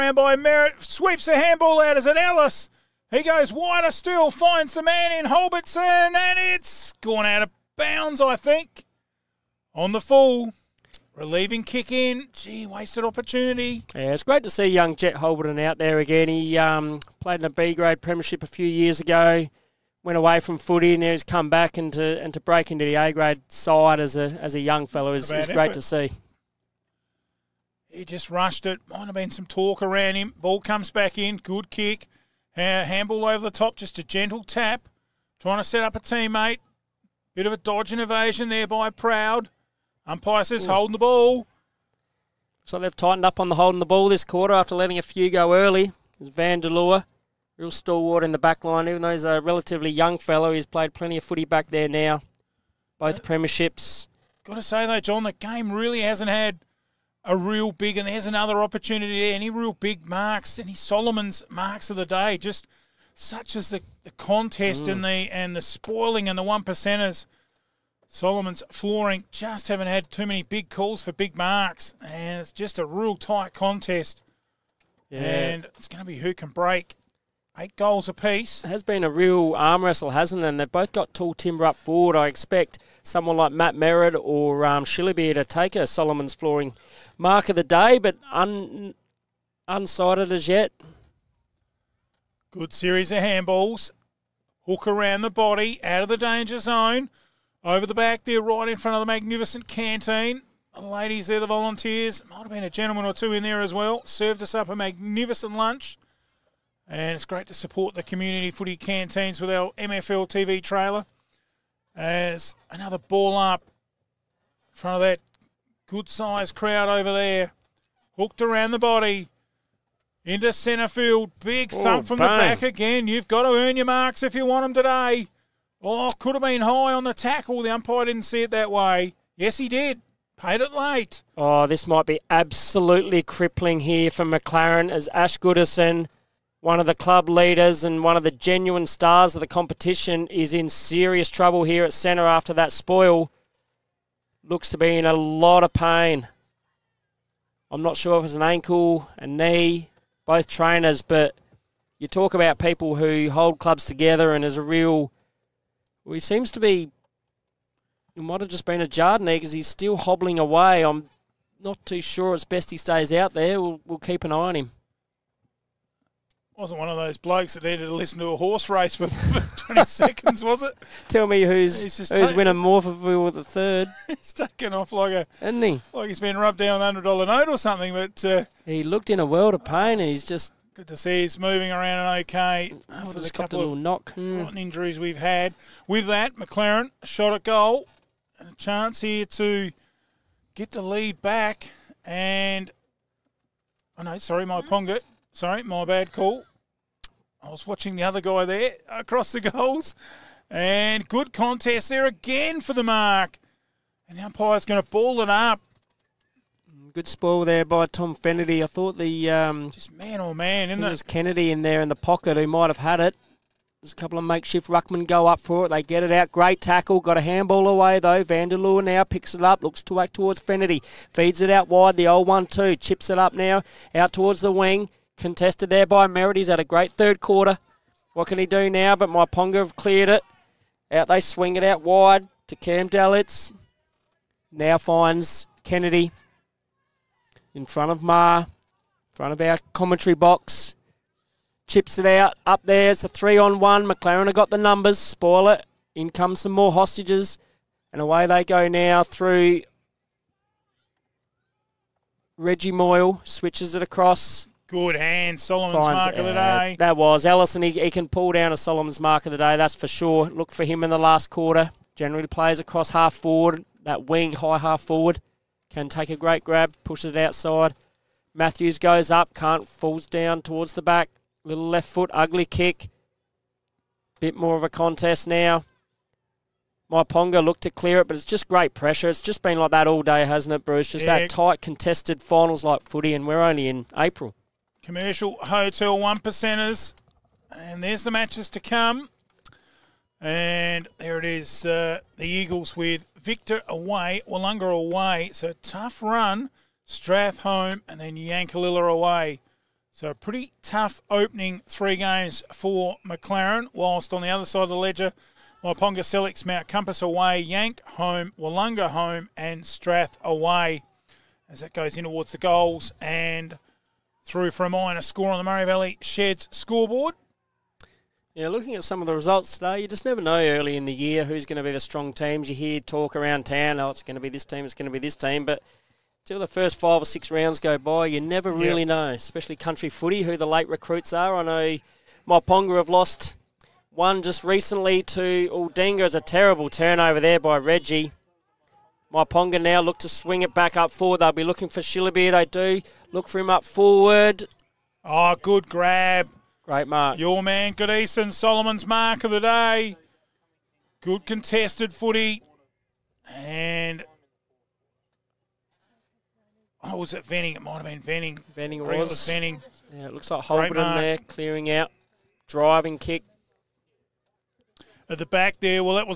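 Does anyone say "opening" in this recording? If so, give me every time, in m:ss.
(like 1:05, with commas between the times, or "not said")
5:01.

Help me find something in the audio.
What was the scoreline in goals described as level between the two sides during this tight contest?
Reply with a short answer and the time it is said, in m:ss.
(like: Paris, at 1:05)
8 goals apiece, at 1:17.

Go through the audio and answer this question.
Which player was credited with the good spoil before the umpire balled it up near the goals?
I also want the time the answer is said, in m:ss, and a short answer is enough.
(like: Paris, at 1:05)
Tom Fennedy, at 3:27.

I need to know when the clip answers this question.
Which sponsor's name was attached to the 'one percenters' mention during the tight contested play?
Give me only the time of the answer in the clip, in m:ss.
4:44.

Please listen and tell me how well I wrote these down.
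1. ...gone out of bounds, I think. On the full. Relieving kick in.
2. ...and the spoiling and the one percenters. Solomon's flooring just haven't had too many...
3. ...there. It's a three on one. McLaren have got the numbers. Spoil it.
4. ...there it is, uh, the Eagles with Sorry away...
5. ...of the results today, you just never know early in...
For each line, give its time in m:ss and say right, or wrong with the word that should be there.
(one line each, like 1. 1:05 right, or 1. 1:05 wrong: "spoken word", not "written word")
1. 0:06 right
2. 1:05 right
3. 4:02 right
4. 4:50 wrong: "Victor", not "Sorry"
5. 5:18 right.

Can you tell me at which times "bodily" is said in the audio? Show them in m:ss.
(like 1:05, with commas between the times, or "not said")
not said.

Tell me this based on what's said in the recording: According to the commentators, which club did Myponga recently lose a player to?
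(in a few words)
Aldinga.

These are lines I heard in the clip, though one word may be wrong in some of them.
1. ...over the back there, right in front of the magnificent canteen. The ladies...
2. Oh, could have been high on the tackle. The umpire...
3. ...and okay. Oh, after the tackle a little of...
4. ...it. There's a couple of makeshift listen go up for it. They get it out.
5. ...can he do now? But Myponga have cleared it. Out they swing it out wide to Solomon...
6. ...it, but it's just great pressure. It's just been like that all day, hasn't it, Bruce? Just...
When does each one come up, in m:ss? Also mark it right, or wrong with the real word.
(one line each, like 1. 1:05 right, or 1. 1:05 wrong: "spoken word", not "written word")
1. 1:37 right
2. 2:05 right
3. 3:02 wrong: "couple", not "tackle"
4. 3:33 wrong: "ruckmen", not "listen"
5. 3:48 wrong: "Cam", not "Solomon"
6. 4:37 right.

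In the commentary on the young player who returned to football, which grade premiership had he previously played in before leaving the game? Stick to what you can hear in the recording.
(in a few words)
B grade.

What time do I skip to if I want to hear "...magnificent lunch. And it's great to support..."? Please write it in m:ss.
1:44.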